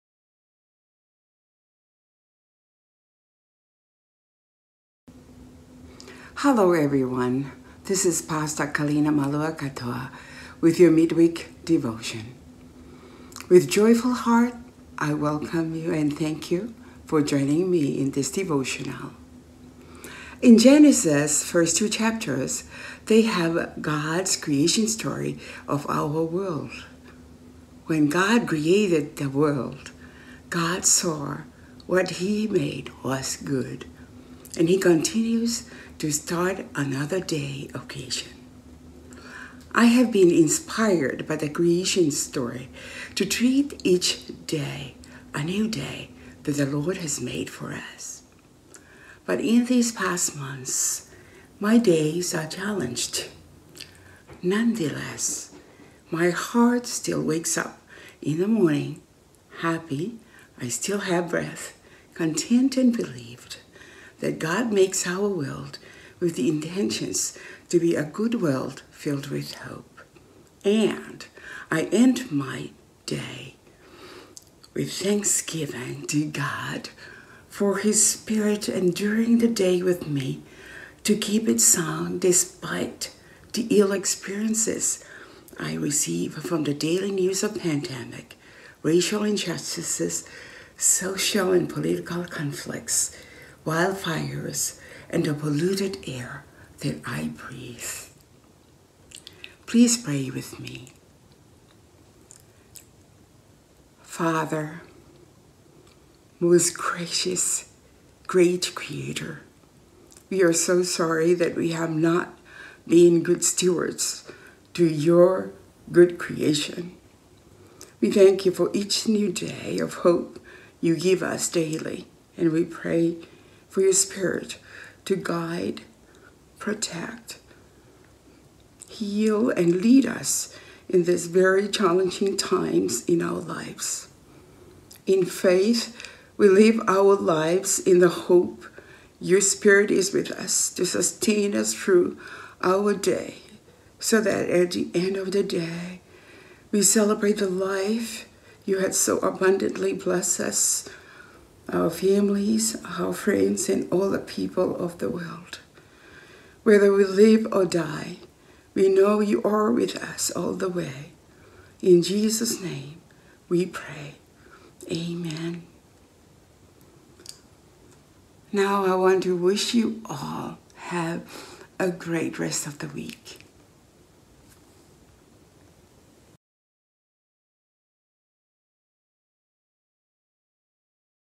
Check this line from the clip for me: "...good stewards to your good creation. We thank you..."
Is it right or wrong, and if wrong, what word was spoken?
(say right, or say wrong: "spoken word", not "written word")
right.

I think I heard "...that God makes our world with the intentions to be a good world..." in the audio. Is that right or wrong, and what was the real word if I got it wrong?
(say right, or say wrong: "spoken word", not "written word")
right.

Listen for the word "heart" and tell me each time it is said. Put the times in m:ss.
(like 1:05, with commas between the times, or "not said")
0:14, 0:56.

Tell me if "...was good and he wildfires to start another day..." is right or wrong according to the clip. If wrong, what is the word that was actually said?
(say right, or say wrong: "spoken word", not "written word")
wrong: "continues", not "wildfires".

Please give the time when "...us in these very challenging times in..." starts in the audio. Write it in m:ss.
2:10.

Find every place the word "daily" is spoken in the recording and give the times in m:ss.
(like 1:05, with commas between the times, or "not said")
1:26, 2:01.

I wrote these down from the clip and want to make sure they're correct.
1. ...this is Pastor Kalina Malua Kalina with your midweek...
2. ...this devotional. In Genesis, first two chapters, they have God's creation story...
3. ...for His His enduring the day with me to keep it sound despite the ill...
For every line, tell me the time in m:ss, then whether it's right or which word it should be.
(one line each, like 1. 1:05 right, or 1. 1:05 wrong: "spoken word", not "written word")
1. 0:07 wrong: "Katoa", not "Kalina"
2. 0:18 right
3. 1:17 wrong: "Spirit", not "His".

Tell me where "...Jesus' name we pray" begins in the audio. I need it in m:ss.
2:42.